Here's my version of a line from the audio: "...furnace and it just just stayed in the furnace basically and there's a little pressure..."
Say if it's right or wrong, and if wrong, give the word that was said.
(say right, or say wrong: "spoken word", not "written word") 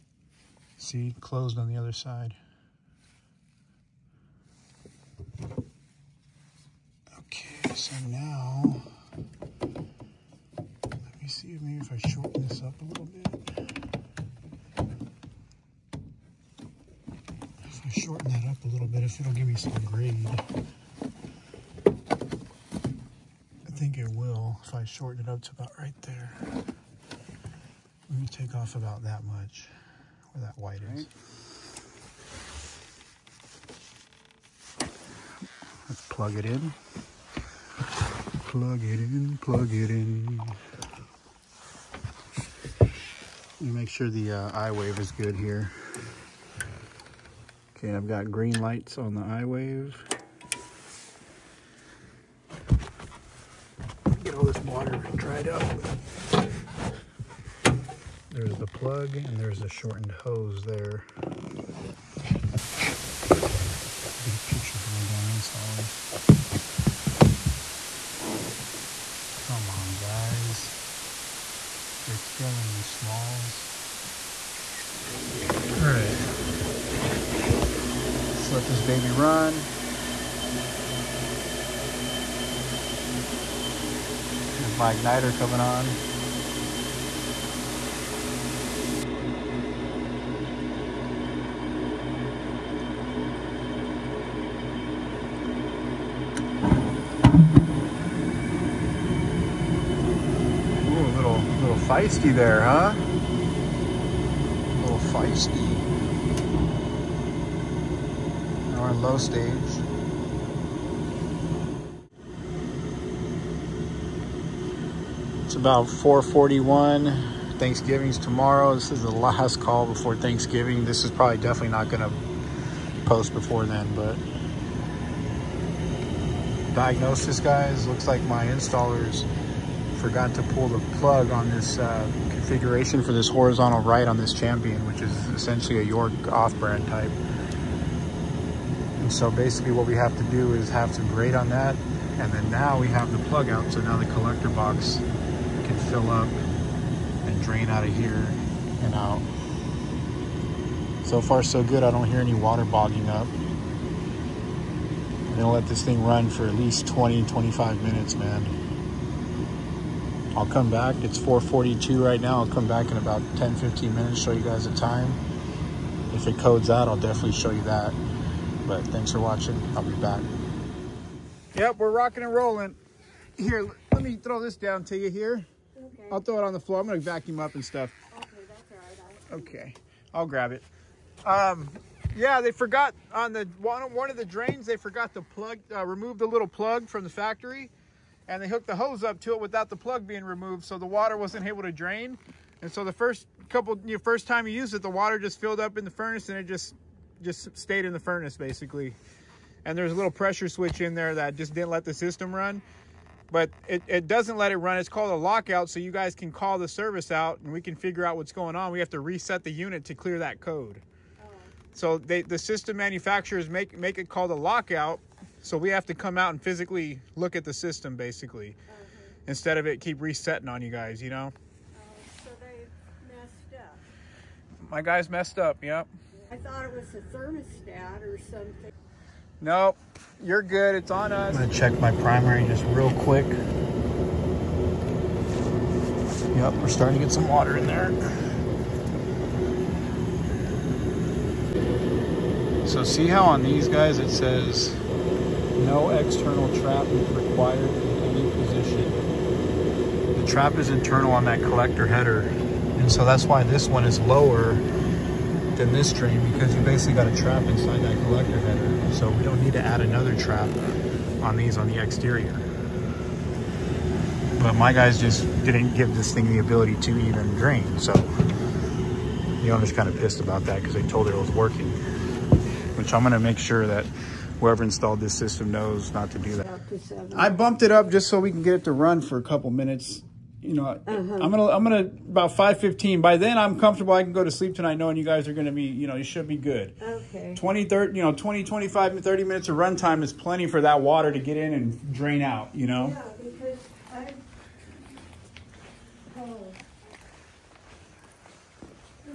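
right.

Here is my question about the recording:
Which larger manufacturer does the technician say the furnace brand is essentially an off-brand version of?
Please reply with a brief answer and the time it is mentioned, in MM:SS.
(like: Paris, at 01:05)
York, at 02:15.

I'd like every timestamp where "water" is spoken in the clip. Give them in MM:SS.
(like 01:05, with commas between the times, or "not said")
00:54, 02:32, 03:10, 03:14, 03:57, 04:50.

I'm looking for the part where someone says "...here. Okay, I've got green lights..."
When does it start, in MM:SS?
00:45.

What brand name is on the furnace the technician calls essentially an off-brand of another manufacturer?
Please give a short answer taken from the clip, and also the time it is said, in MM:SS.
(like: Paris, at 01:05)
Champion, at 02:14.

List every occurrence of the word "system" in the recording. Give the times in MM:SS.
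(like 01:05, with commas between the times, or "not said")
03:21, 03:32, 03:37, 04:35.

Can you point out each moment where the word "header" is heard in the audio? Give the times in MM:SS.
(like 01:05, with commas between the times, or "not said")
04:11, 04:18.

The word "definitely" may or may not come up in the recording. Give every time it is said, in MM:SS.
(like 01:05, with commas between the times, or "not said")
02:01, 02:46.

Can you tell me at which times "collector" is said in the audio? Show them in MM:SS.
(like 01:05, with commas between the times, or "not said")
02:24, 04:11, 04:18.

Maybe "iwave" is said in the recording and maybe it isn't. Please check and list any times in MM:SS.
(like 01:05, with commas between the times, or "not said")
00:44, 00:49.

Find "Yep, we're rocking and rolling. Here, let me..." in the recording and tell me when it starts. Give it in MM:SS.
02:51.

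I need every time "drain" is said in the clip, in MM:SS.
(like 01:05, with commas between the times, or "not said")
02:27, 03:04, 03:11, 04:15, 04:27, 04:51.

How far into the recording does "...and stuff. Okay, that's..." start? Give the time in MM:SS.
02:57.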